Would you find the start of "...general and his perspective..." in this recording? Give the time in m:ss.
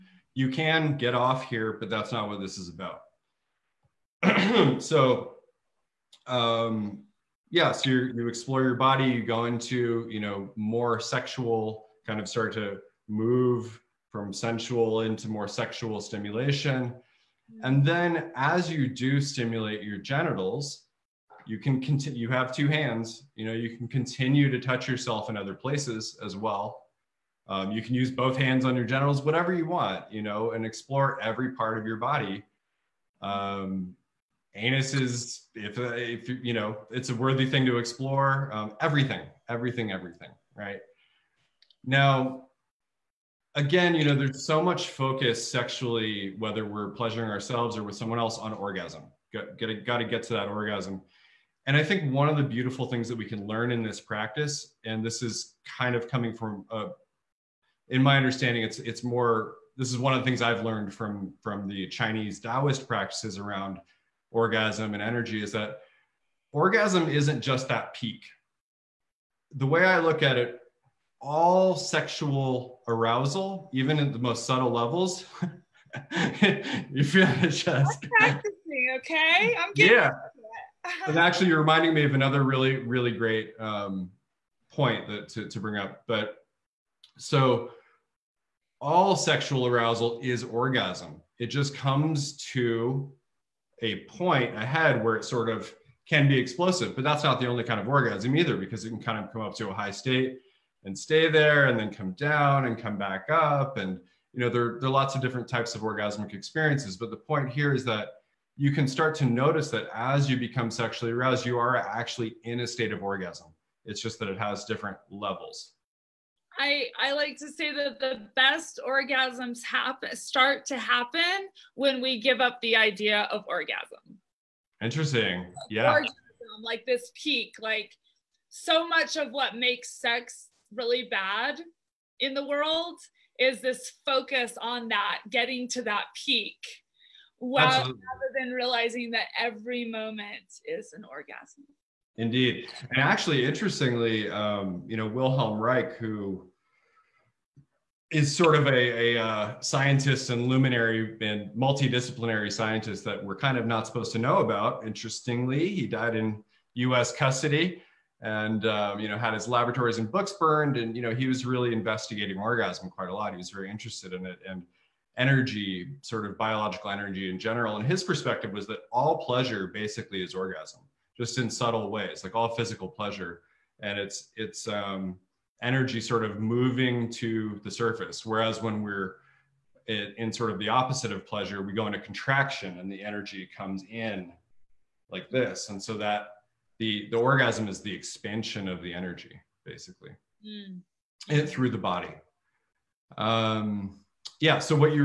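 2:47.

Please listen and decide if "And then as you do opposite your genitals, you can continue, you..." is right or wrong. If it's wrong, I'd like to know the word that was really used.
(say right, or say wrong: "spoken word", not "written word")
wrong: "stimulate", not "opposite".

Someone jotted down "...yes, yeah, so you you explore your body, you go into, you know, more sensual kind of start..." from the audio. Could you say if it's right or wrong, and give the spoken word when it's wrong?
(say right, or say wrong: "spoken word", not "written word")
wrong: "sexual", not "sensual".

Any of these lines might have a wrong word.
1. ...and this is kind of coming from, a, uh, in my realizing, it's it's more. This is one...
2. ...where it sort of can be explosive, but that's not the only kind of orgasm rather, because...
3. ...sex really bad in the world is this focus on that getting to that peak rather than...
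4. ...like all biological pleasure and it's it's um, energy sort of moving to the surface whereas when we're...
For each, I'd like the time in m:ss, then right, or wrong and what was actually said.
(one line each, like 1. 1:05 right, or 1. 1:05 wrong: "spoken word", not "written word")
1. 0:54 wrong: "understanding", not "realizing"
2. 1:35 wrong: "either", not "rather"
3. 2:09 right
4. 2:52 wrong: "physical", not "biological".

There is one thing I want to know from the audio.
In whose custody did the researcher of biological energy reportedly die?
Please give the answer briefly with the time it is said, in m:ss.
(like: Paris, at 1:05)
US custody, at 2:36.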